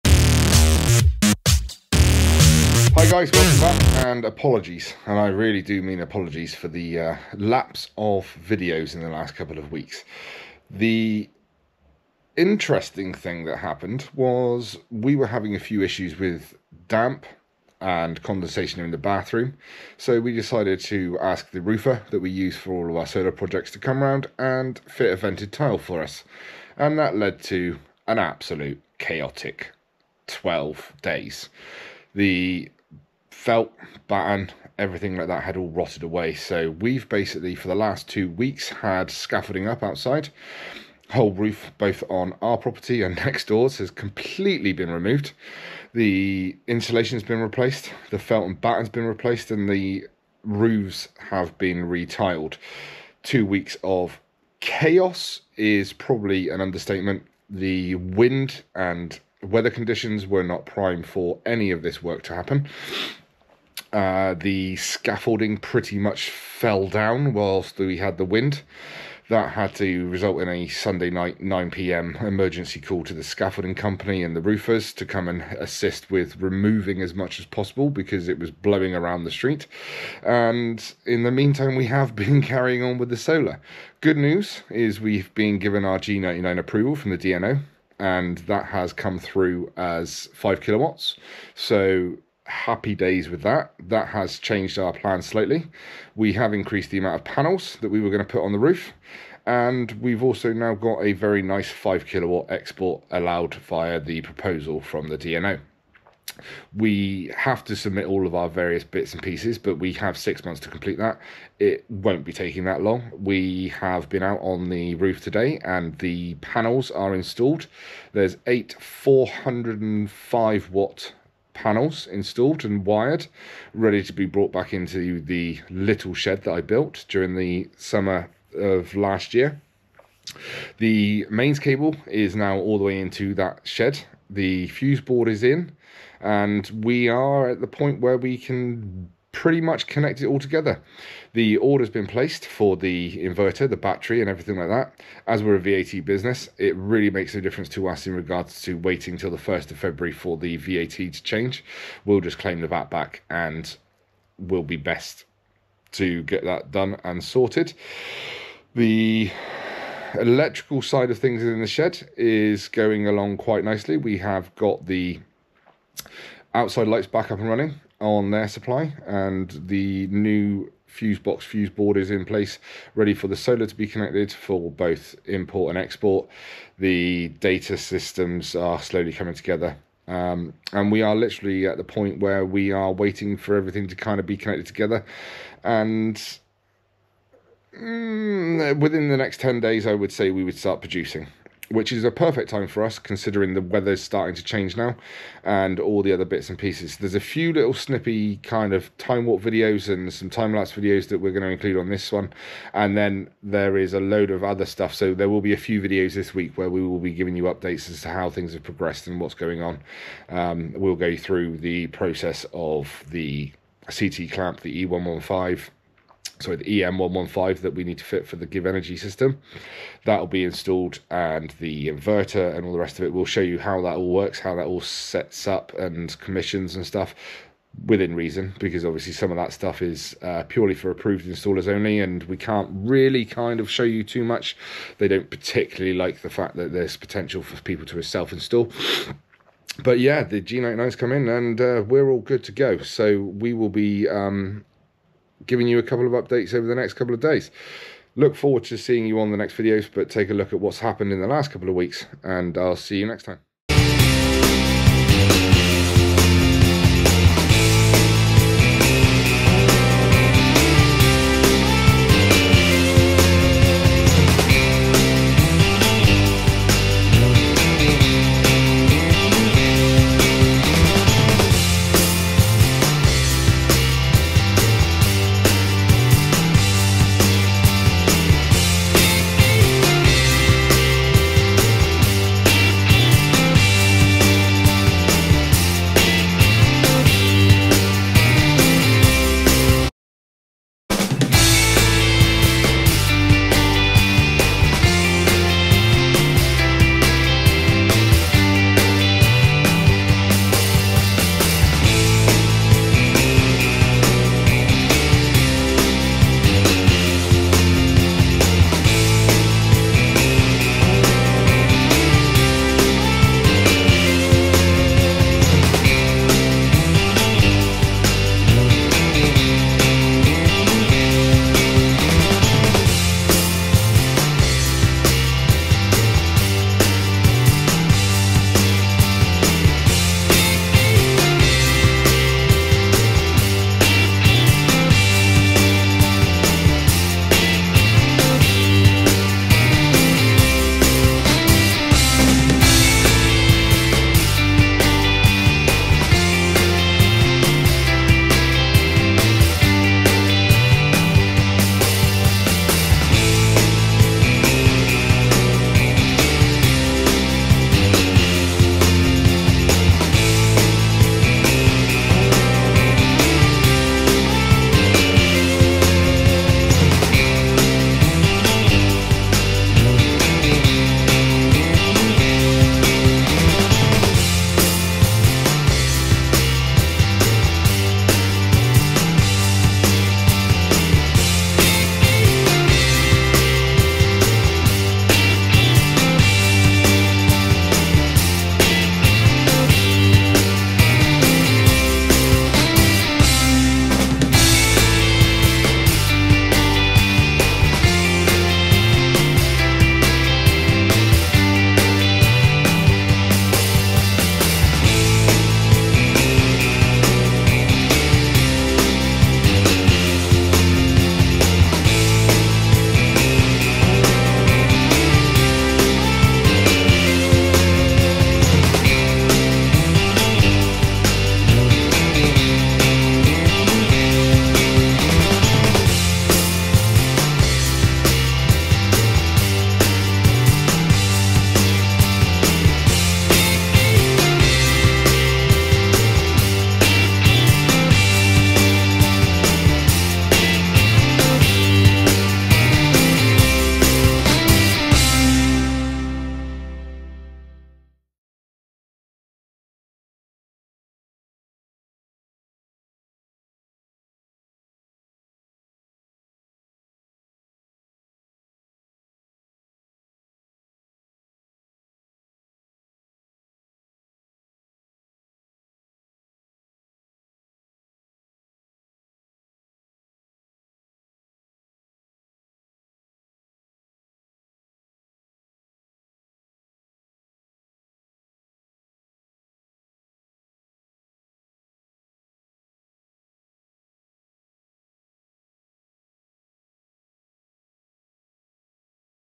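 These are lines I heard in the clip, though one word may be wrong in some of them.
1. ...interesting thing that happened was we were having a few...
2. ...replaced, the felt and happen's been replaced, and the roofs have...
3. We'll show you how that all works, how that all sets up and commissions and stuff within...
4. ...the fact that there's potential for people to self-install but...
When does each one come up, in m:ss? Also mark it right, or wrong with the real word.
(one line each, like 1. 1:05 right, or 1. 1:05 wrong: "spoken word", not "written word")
1. 0:12 right
2. 0:47 wrong: "batten", not "happen"
3. 3:43 right
4. 3:56 right.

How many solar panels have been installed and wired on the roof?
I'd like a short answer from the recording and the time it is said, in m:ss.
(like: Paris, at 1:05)
8, at 1:58.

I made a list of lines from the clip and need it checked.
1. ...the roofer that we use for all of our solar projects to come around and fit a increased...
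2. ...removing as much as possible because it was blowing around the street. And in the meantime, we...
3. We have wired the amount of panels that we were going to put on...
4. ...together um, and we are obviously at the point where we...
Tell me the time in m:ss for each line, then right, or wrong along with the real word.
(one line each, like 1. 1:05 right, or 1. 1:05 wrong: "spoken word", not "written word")
1. 0:21 wrong: "vented", not "increased"
2. 1:16 right
3. 1:36 wrong: "increased", not "wired"
4. 2:59 wrong: "literally", not "obviously".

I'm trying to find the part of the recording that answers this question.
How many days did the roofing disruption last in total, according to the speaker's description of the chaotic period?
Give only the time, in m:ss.
0:30.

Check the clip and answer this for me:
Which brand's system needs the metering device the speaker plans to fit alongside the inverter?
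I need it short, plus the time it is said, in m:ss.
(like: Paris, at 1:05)
GivEnergy, at 3:38.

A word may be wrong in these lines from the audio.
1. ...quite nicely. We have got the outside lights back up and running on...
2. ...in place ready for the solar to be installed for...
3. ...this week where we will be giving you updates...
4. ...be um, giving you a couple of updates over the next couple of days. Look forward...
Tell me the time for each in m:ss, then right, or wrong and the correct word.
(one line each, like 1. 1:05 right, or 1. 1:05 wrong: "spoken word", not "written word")
1. 2:43 right
2. 2:52 wrong: "connected", not "installed"
3. 3:26 right
4. 4:03 right.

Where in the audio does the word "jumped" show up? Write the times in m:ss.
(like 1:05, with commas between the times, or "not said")
not said.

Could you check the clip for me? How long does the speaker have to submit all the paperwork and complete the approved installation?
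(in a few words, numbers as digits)
six months.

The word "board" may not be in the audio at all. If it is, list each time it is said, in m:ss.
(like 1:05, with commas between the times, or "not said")
2:15, 2:51.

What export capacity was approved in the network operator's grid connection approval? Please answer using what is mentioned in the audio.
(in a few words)
5 kilowatts.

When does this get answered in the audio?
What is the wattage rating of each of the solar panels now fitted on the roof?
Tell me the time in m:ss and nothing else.
1:58.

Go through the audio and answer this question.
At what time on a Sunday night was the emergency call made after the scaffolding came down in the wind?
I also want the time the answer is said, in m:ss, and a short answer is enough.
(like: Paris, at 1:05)
9 pm, at 1:11.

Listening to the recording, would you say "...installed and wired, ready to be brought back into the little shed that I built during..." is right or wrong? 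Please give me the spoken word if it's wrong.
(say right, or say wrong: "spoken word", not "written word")
right.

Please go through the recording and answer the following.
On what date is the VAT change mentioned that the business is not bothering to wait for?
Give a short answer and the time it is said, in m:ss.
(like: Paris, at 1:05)
1st of February, at 2:29.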